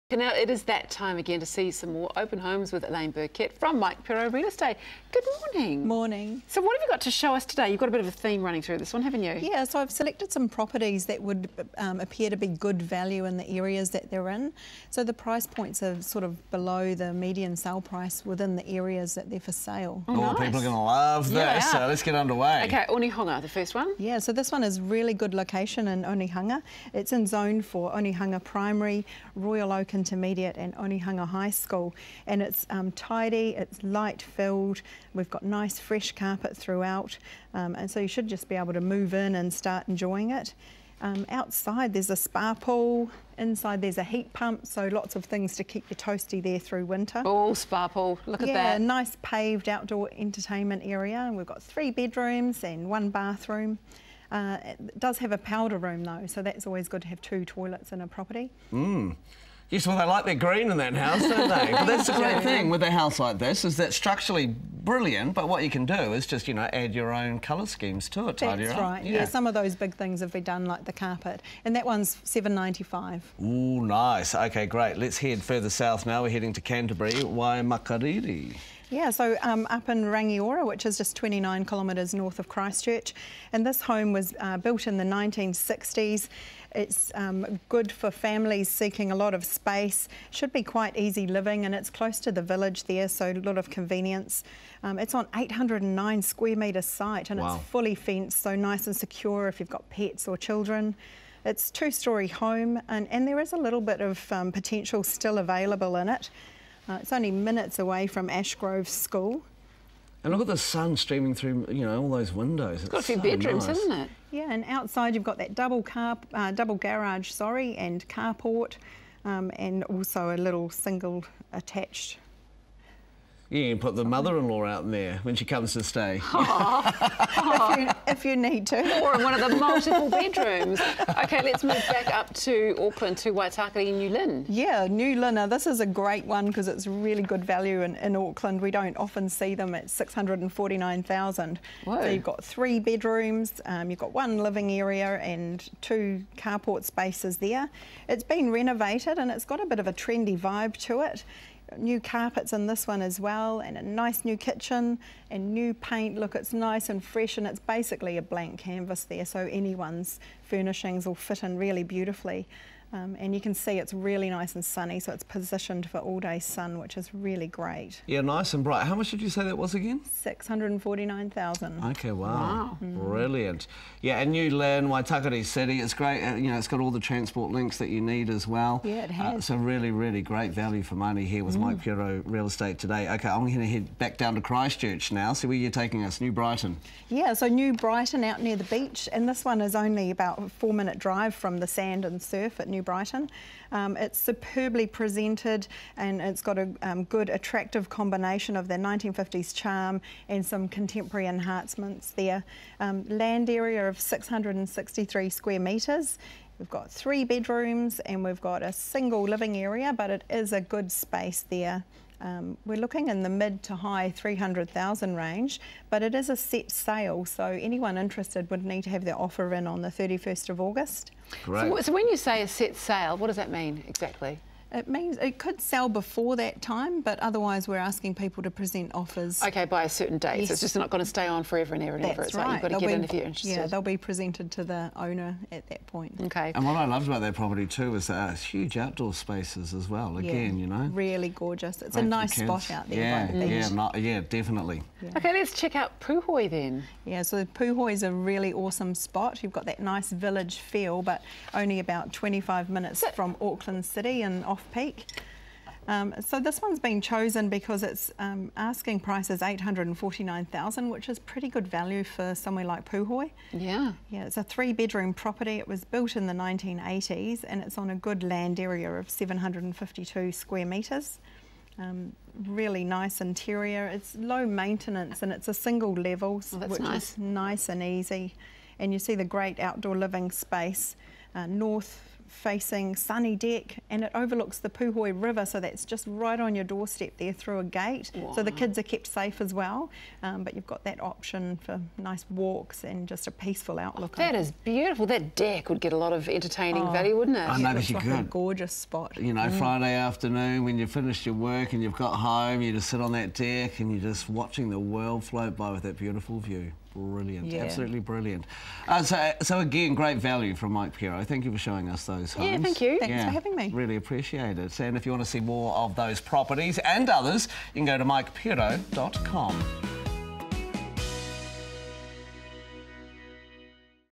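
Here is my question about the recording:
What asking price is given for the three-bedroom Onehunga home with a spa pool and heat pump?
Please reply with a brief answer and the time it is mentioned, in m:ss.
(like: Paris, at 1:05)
795, at 1:12.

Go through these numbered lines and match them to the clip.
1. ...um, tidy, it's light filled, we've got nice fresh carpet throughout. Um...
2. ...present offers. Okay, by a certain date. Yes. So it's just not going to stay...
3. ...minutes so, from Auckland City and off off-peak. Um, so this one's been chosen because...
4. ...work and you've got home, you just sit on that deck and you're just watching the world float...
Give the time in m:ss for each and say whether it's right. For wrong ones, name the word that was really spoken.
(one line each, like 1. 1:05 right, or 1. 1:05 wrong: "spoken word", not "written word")
1. 0:32 right
2. 3:48 right
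3. 4:12 right
4. 5:01 right.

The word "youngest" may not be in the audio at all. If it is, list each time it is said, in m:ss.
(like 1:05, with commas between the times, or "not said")
not said.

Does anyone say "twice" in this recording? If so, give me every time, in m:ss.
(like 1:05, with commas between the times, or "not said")
not said.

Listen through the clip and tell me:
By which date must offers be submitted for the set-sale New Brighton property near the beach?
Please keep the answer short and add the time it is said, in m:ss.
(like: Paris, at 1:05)
31st of August, at 3:39.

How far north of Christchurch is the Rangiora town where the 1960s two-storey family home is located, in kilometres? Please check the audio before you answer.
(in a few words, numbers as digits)
29.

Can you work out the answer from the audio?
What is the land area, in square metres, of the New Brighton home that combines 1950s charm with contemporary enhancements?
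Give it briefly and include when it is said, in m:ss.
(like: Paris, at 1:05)
663, at 3:23.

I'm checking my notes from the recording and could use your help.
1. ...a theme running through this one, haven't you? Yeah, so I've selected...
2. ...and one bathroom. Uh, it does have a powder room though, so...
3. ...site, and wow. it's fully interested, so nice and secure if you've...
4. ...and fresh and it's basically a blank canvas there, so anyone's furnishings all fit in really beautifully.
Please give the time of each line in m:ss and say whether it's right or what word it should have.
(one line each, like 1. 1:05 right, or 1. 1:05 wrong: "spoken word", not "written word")
1. 0:08 right
2. 0:52 right
3. 1:36 wrong: "fenced", not "interested"
4. 2:36 right.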